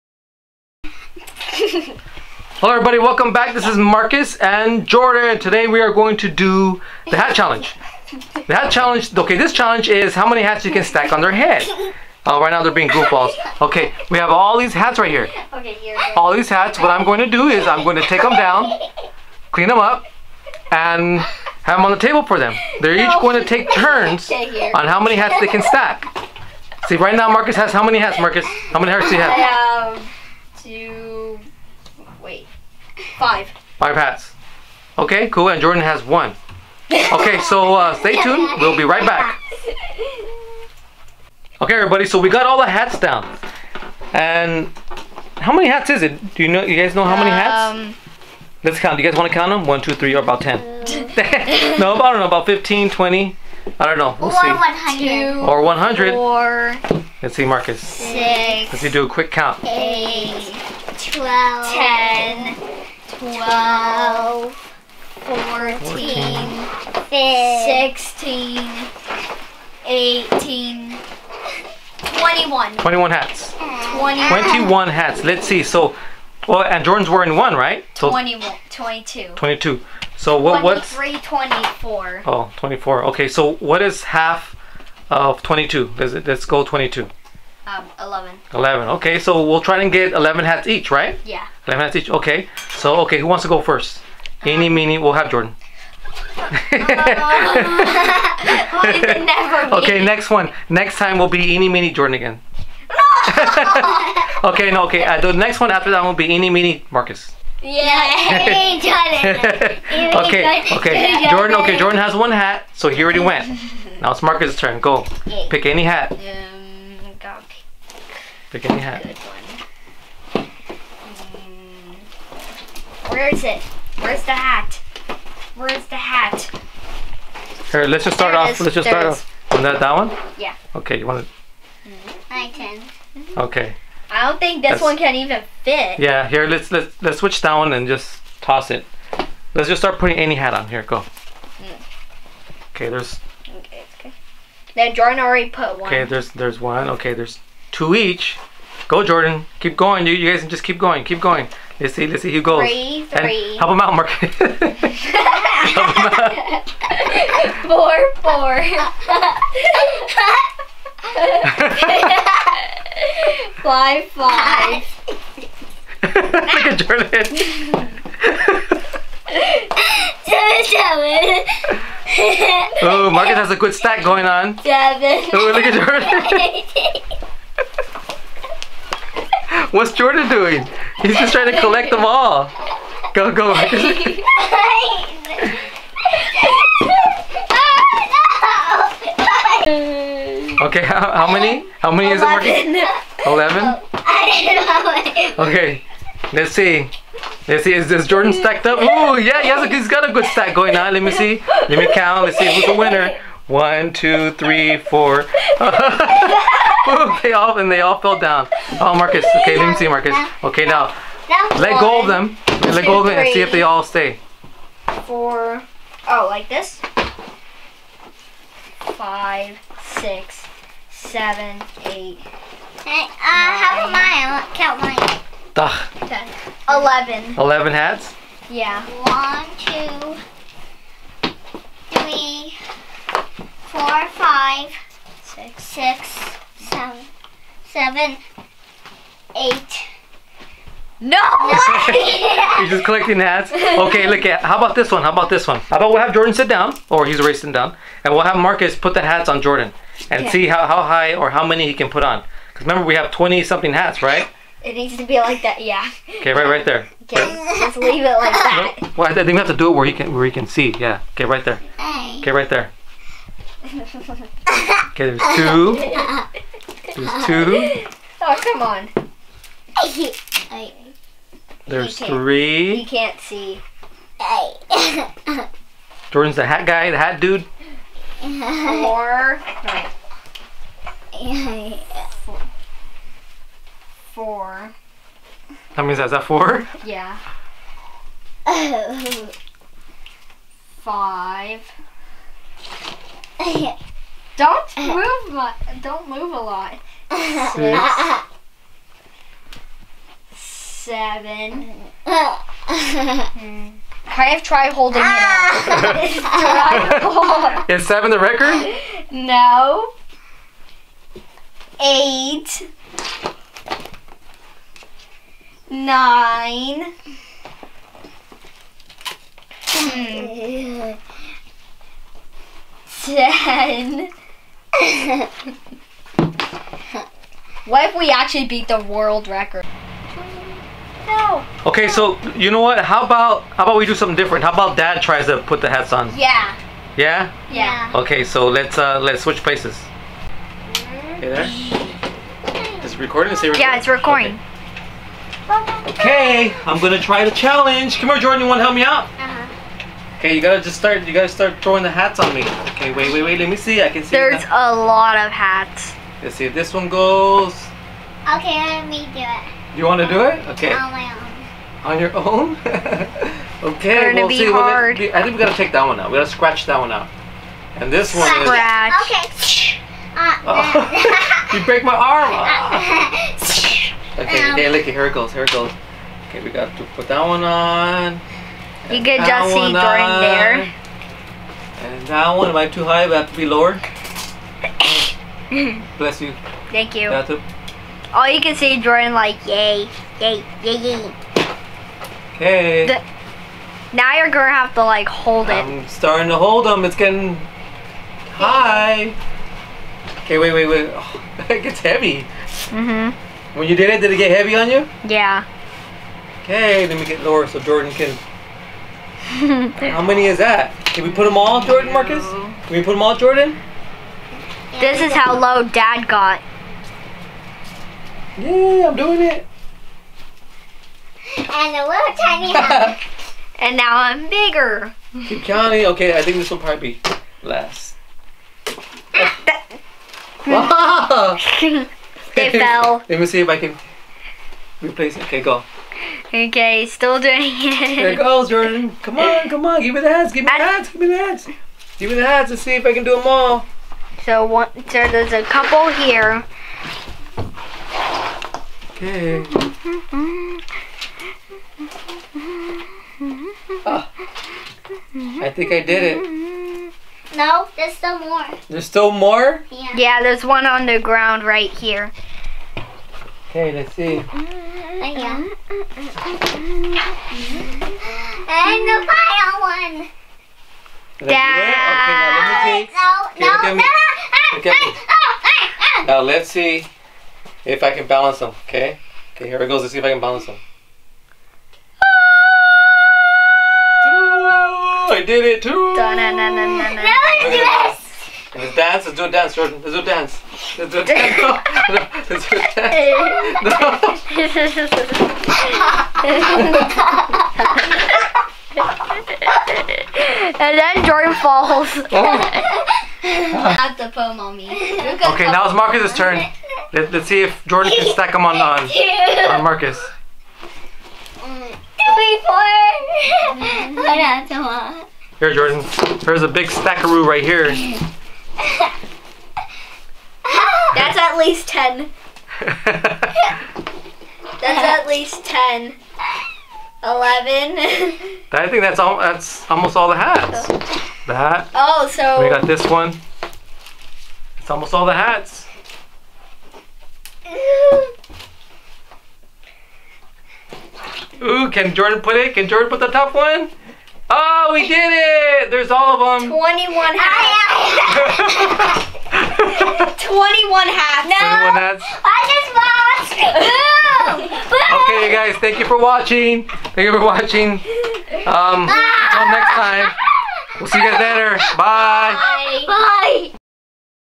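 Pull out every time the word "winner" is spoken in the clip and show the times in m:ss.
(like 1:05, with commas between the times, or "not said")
3:22.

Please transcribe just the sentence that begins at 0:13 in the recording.
Okay, we have all these hats right here.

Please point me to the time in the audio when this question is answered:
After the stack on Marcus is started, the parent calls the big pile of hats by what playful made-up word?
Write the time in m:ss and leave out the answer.
8:36.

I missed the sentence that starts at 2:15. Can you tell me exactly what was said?
Yeah, here let's let's let's switch down and just toss it.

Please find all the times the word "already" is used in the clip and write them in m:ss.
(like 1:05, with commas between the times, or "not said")
1:53, 2:25.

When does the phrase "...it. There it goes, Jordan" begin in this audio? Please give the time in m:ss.
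7:17.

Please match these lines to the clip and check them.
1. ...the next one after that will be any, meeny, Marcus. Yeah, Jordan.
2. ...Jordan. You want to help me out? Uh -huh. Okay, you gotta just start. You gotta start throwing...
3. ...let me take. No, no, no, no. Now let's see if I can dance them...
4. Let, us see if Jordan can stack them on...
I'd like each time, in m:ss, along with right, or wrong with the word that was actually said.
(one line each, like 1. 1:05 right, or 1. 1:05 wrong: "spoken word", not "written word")
1. 1:45 right
2. 5:48 right
3. 7:52 wrong: "balance", not "dance"
4. 8:26 right.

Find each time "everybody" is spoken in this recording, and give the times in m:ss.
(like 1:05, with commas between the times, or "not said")
0:02, 0:41.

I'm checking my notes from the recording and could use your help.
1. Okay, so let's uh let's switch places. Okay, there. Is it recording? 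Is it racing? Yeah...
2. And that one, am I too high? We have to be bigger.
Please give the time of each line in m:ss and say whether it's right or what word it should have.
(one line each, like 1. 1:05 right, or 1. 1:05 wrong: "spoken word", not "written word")
1. 5:37 wrong: "recording", not "racing"
2. 6:21 wrong: "lower", not "bigger".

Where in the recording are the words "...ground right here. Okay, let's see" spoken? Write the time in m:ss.
7:40.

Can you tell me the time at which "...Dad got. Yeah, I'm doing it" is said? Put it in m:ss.
6:55.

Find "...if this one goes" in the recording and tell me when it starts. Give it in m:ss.
5:56.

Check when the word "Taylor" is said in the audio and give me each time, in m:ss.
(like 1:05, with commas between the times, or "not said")
not said.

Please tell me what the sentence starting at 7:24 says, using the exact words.
So one, so there's a couple here.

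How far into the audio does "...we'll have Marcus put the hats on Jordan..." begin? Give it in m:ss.
4:08.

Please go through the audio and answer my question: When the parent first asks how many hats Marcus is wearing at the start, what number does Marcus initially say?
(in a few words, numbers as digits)
2.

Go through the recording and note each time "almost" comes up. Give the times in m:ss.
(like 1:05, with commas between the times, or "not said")
8:49, 8:54.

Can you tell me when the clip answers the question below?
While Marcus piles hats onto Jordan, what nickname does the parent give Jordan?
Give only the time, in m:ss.
4:36.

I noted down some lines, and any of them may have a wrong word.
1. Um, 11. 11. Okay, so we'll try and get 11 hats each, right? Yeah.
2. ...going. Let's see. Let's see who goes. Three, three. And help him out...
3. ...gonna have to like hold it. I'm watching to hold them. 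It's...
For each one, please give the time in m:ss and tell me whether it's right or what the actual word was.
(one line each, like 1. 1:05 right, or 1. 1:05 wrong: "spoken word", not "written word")
1. 1:27 right
2. 2:31 right
3. 6:34 wrong: "starting", not "watching".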